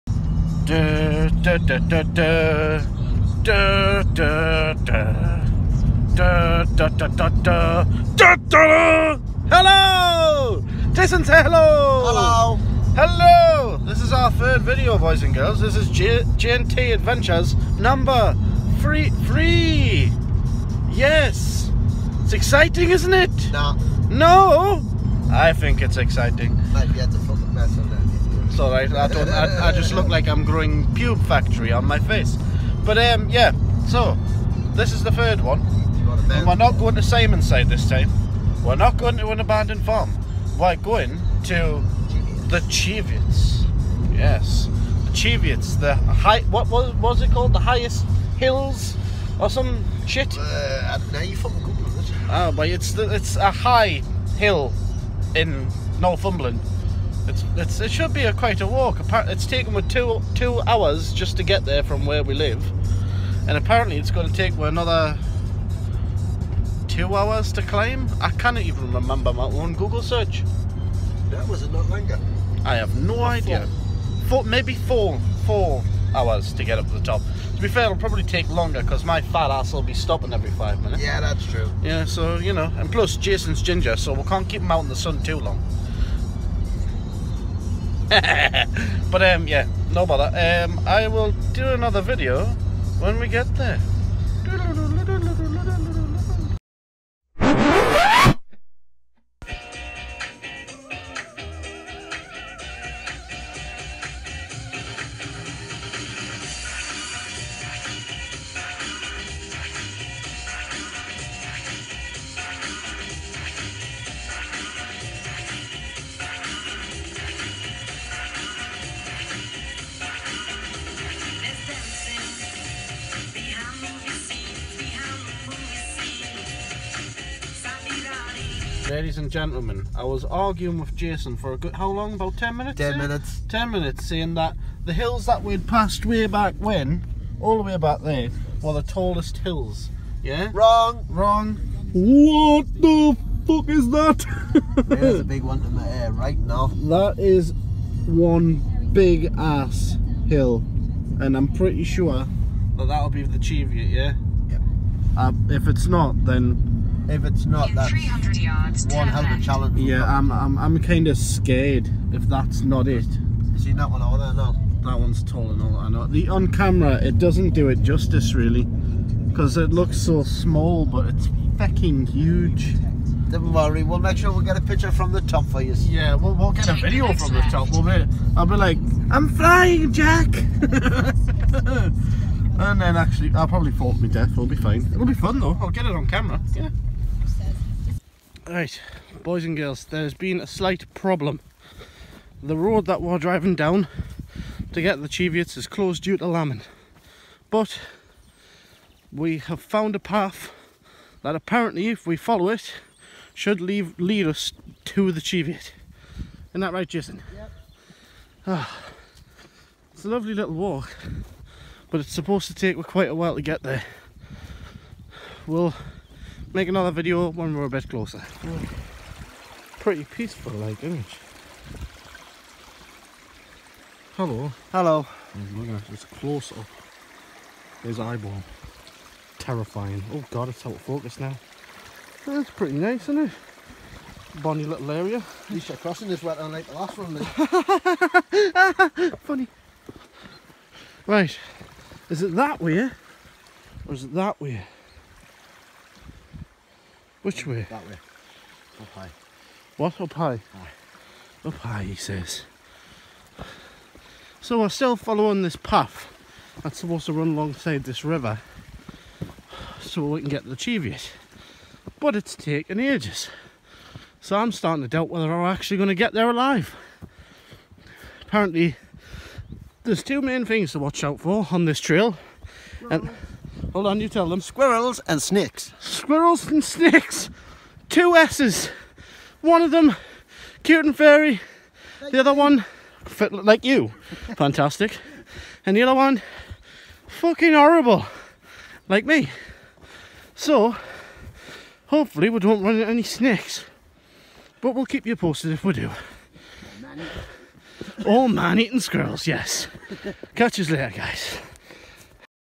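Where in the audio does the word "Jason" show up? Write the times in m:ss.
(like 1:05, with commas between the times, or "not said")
0:10, 1:23, 2:10, 3:26.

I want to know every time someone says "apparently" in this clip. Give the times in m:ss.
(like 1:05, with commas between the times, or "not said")
1:03, 3:21, 4:28.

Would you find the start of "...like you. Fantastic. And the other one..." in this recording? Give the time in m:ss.
4:43.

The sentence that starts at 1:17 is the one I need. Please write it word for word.
To be fair, it'll probably take longer because my fat ass will be stopping every five minutes.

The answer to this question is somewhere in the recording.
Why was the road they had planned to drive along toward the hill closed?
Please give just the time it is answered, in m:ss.
3:16.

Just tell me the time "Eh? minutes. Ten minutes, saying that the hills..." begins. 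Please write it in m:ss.
2:13.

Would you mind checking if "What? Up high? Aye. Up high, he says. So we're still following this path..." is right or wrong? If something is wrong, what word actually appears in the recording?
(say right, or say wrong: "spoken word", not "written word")
right.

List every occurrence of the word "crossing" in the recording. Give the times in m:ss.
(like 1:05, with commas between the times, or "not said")
3:55.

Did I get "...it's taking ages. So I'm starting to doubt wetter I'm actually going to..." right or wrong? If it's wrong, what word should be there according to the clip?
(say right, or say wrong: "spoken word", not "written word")
wrong: "whether", not "wetter".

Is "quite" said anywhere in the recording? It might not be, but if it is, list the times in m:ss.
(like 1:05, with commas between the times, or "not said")
0:58, 3:32.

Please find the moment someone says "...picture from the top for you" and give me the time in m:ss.
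2:54.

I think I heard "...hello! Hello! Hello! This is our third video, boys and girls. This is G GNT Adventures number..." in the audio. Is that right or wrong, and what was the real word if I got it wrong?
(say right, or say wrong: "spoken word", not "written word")
right.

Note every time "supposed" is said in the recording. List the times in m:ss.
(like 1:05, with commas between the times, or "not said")
3:32, 4:16.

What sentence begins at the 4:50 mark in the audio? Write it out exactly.
So hopefully we don't run into any snakes.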